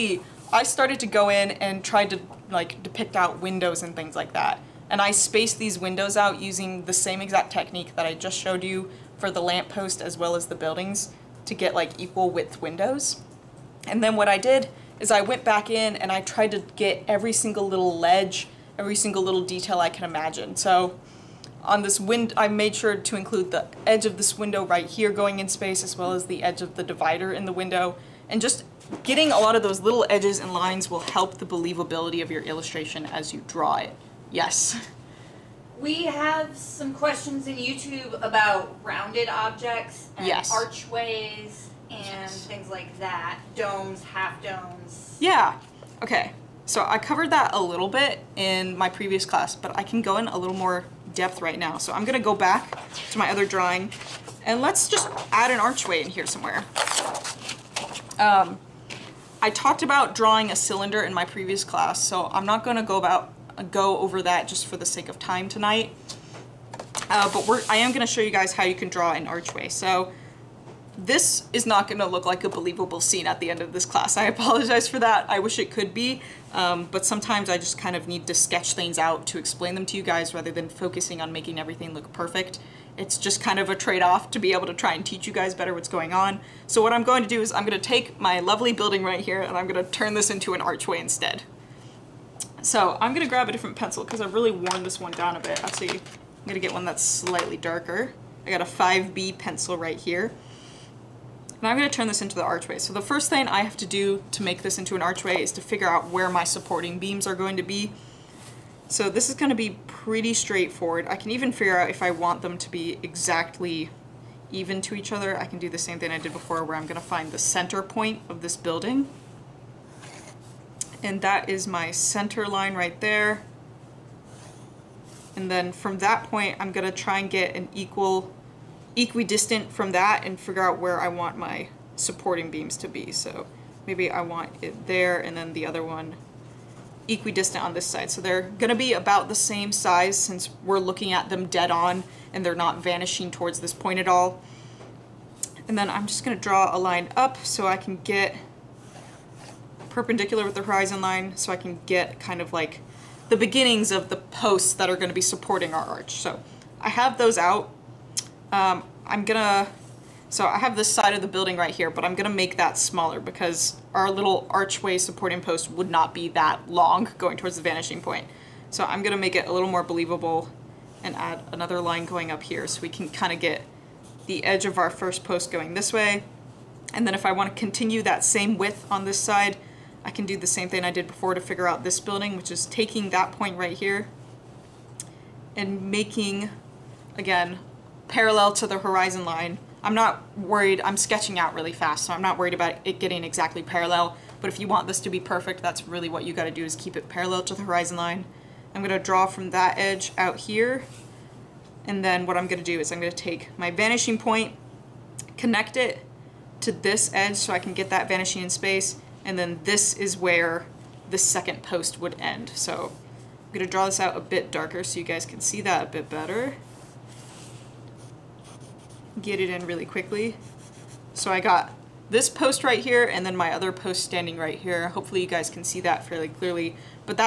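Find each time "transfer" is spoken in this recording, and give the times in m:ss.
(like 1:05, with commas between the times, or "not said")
not said.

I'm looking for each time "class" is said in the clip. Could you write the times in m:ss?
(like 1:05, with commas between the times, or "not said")
0:49, 1:01, 1:13.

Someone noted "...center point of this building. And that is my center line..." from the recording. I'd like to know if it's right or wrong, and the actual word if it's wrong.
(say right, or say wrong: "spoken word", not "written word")
right.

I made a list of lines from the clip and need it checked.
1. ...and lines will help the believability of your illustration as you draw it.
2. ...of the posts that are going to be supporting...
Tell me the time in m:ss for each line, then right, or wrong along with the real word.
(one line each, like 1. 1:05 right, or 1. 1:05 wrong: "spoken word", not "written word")
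1. 0:30 right
2. 2:33 right.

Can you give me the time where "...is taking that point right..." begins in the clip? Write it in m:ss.
3:02.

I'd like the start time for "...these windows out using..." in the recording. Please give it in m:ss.
0:05.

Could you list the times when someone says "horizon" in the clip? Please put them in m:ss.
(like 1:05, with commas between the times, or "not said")
2:30, 3:08, 3:17.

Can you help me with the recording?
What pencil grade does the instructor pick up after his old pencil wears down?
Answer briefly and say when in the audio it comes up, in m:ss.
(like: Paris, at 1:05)
5B, at 1:38.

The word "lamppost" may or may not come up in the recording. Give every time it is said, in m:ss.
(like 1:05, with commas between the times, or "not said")
0:09.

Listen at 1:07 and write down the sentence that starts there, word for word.
Uh, but I am going to show you guys how you can draw an archway.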